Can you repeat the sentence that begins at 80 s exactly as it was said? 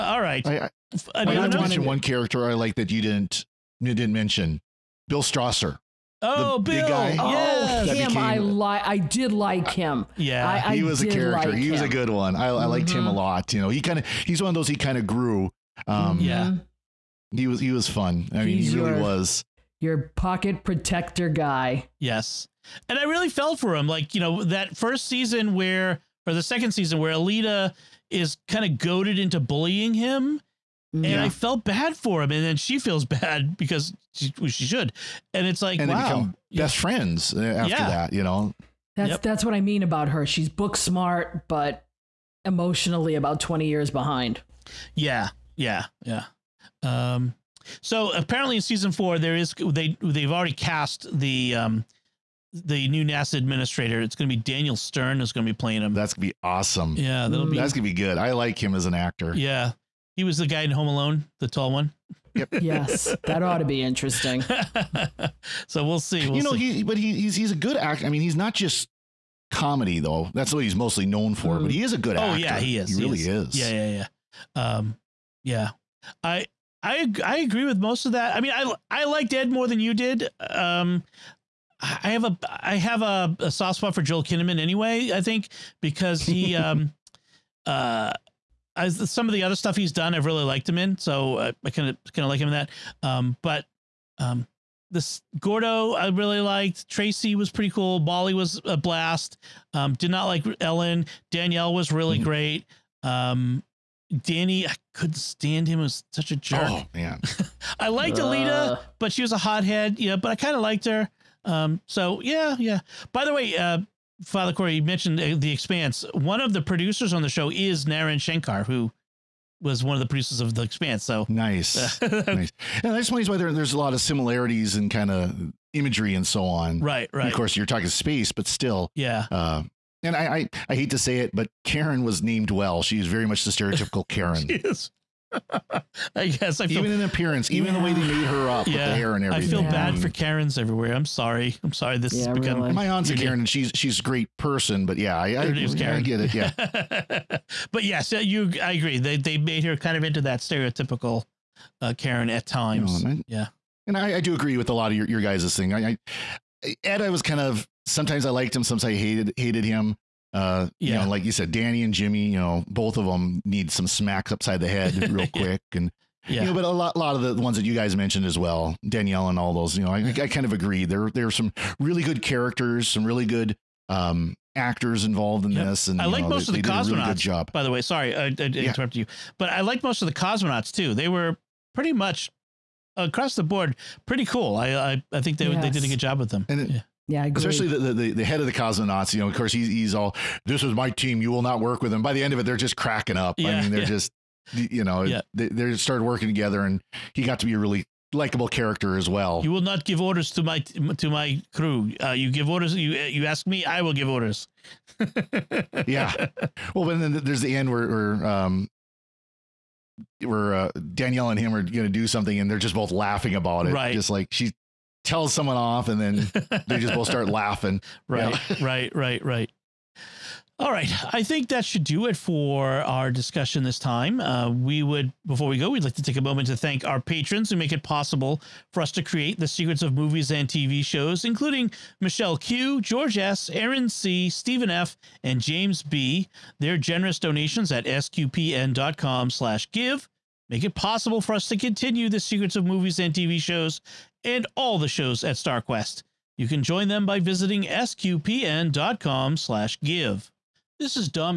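Um, I have a I have a, a soft spot for Joel Kinnaman anyway.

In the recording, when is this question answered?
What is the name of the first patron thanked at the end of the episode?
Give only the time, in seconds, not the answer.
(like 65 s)
232 s.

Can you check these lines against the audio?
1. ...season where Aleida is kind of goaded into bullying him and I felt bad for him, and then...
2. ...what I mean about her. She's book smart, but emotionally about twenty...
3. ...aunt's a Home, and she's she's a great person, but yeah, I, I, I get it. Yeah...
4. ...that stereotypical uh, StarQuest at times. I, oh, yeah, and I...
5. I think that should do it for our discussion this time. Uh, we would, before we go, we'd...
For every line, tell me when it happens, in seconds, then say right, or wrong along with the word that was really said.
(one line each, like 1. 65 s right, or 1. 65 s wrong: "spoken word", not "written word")
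1. 26 s right
2. 39 s right
3. 142 s wrong: "Karen", not "Home"
4. 150 s wrong: "Karen", not "StarQuest"
5. 221 s right.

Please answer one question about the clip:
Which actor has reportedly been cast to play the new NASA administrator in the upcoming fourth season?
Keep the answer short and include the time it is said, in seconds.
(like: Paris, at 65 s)
Daniel Stern, at 54 s.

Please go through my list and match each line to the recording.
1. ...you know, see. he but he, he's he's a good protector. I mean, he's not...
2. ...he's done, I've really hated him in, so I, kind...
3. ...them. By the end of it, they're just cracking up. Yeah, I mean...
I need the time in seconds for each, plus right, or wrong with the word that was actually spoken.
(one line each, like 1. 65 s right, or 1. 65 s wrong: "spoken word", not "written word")
1. 66 s wrong: "actor", not "protector"
2. 89 s wrong: "liked", not "hated"
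3. 191 s right.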